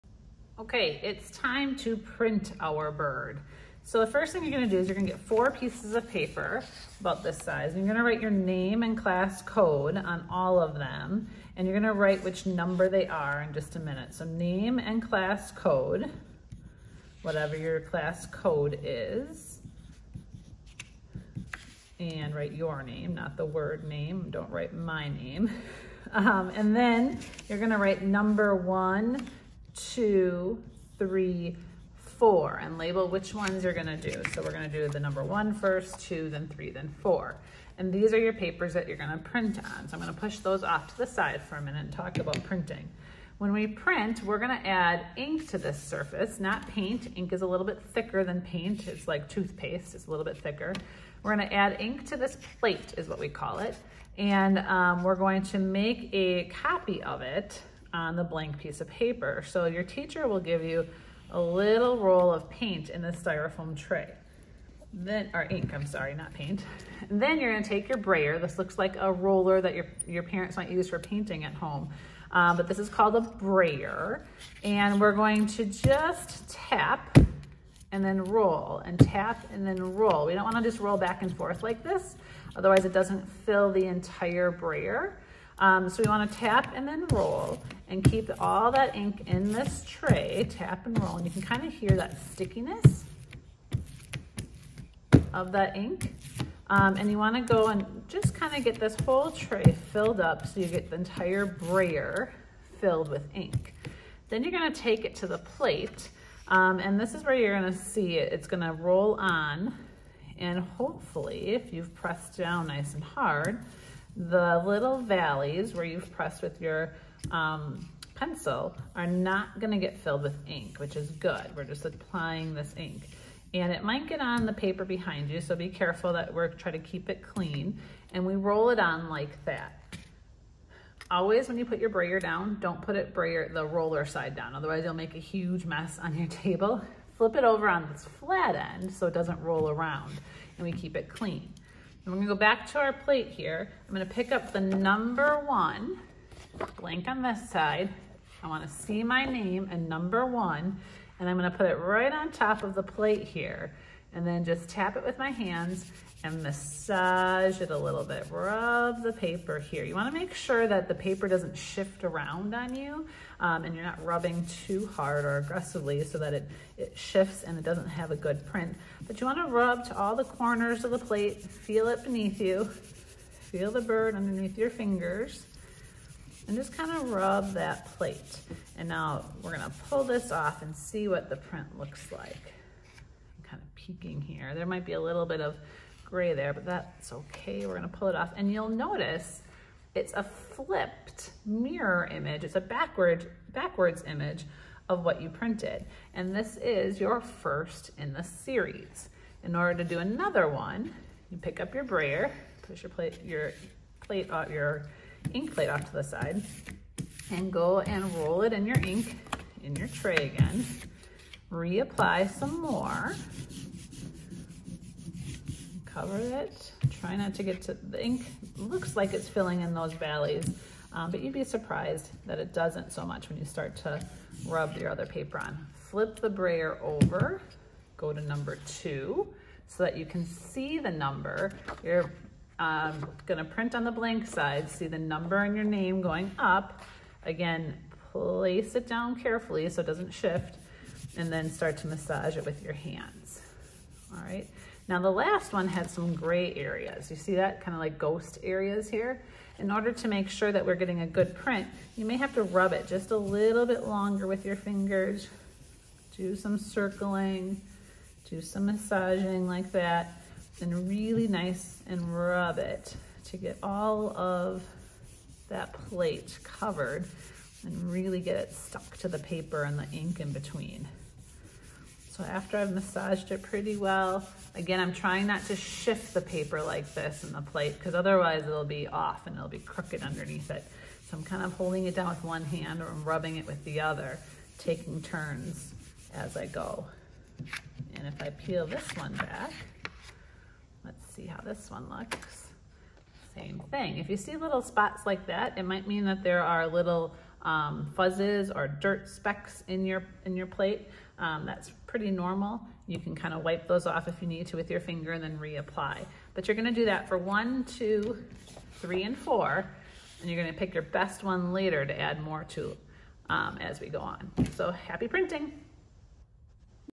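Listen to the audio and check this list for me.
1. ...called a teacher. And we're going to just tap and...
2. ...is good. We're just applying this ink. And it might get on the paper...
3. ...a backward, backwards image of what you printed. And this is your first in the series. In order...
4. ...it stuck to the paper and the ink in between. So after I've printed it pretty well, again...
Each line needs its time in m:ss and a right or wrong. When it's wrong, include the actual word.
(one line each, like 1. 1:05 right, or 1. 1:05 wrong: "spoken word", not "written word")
1. 1:12 wrong: "brayer", not "teacher"
2. 2:00 right
3. 3:12 right
4. 4:28 wrong: "massaged", not "printed".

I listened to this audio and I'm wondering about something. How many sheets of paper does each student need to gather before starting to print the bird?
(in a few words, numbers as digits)
4.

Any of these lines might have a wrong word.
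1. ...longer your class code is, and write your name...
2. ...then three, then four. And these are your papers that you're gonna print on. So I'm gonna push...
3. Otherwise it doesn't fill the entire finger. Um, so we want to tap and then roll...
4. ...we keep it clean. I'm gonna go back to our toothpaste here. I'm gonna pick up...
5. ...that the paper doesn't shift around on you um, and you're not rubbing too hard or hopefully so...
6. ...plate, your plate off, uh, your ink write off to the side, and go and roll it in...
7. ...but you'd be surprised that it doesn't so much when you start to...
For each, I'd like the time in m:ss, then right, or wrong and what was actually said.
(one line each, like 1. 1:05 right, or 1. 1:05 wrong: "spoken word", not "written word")
1. 0:17 wrong: "whatever", not "longer"
2. 0:36 right
3. 1:22 wrong: "brayer", not "finger"
4. 2:20 wrong: "plate", not "toothpaste"
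5. 2:40 wrong: "aggressively", not "hopefully"
6. 3:22 wrong: "plate", not "write"
7. 3:41 right.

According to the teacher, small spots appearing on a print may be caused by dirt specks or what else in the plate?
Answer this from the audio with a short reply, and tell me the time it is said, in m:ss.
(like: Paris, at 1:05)
fuzzes, at 4:57.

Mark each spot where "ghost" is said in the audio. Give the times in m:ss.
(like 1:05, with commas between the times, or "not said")
4:07.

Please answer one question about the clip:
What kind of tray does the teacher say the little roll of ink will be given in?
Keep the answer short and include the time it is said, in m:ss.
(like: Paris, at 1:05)
styrofoam tray, at 1:03.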